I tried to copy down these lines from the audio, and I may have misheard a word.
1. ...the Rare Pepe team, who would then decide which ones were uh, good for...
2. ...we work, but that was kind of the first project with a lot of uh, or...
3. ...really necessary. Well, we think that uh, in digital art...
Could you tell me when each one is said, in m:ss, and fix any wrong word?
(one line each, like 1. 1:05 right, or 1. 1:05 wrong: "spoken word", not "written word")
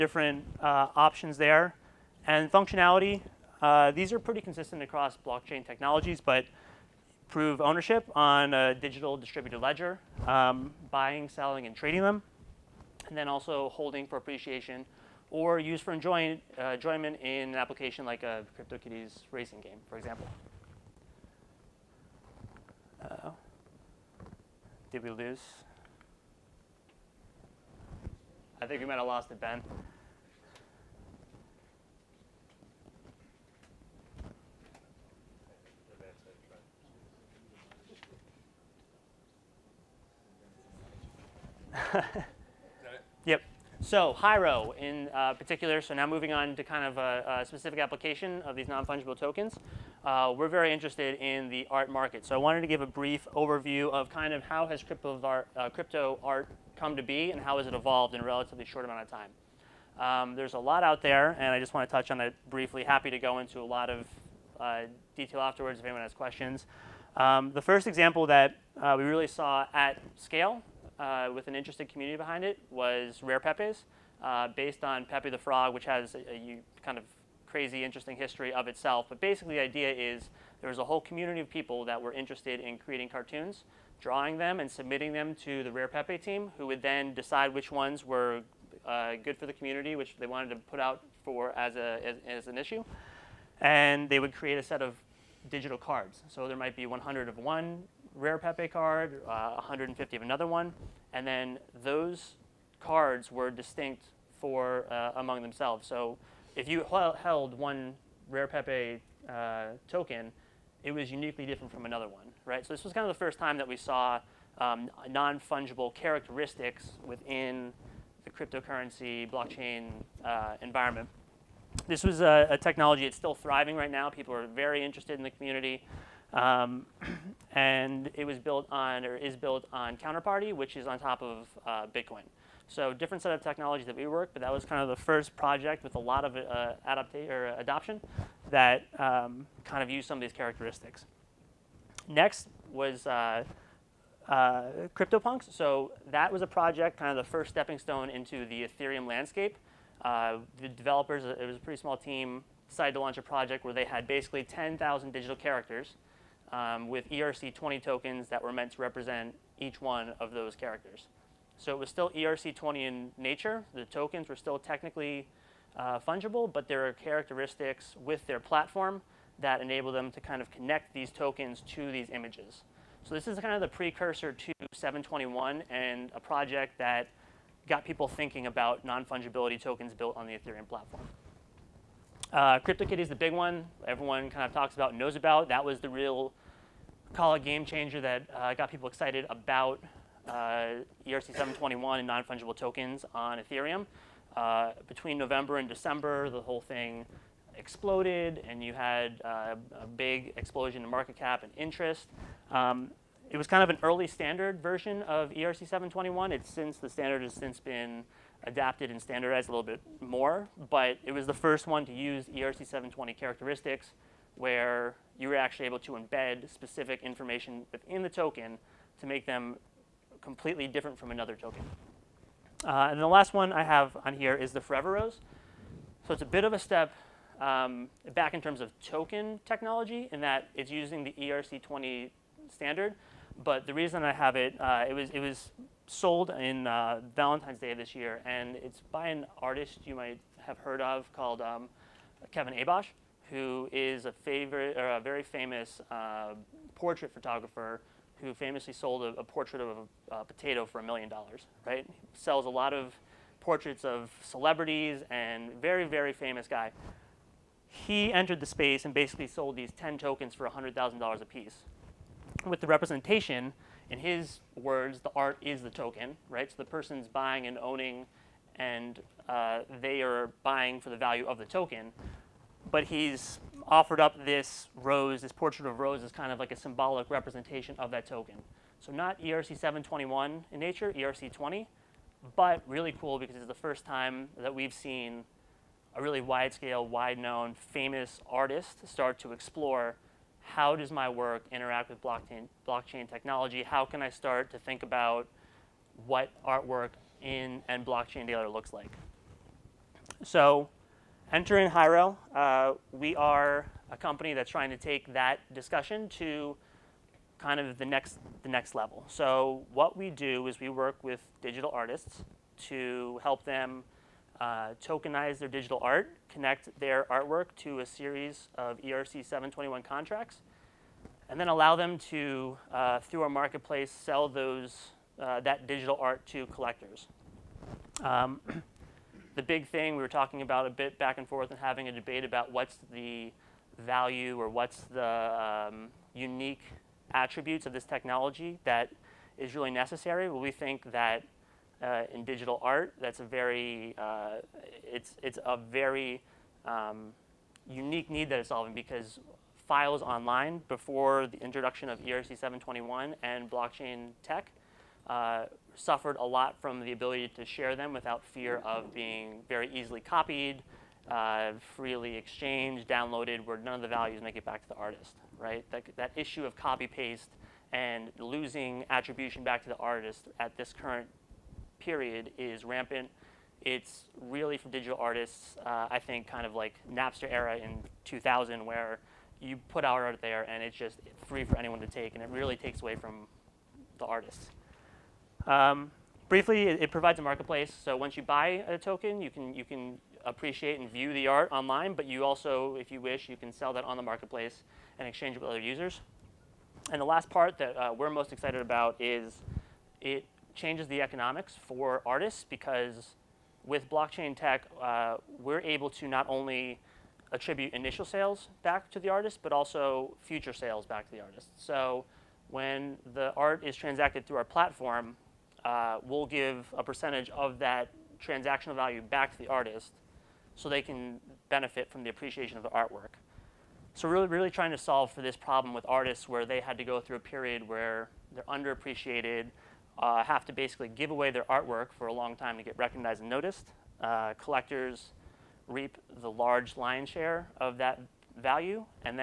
1. 1:25 right
2. 2:13 right
3. 5:39 right.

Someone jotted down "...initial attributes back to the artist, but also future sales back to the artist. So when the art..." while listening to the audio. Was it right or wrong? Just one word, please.
wrong.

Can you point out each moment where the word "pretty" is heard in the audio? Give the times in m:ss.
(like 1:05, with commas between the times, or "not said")
0:04, 2:31.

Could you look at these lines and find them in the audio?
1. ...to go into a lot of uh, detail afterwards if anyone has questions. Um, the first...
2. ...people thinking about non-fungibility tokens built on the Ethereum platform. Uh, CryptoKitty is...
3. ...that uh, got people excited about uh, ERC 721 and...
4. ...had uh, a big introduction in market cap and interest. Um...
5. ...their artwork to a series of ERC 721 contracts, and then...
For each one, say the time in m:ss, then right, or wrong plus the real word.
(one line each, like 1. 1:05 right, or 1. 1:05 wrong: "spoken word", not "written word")
1. 1:03 right
2. 2:57 right
3. 3:07 right
4. 3:18 wrong: "explosion", not "introduction"
5. 5:16 right.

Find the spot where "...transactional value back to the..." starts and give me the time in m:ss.
6:58.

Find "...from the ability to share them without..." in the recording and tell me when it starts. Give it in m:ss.
5:56.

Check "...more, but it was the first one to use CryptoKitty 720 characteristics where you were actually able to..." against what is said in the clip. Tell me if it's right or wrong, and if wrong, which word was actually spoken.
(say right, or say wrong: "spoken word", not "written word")
wrong: "ERC", not "CryptoKitty".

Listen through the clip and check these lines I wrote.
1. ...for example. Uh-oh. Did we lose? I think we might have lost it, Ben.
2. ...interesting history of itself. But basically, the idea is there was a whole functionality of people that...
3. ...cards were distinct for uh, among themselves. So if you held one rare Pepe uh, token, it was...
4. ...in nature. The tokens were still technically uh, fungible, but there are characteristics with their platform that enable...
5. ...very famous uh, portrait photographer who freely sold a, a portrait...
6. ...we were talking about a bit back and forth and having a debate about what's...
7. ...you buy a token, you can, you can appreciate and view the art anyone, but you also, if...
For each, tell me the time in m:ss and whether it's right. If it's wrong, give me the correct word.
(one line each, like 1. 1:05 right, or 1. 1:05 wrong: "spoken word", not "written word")
1. 0:19 right
2. 1:17 wrong: "community", not "functionality"
3. 1:42 right
4. 2:42 right
5. 4:04 wrong: "famously", not "freely"
6. 5:29 right
7. 6:28 wrong: "online", not "anyone".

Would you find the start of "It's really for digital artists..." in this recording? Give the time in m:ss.
6:13.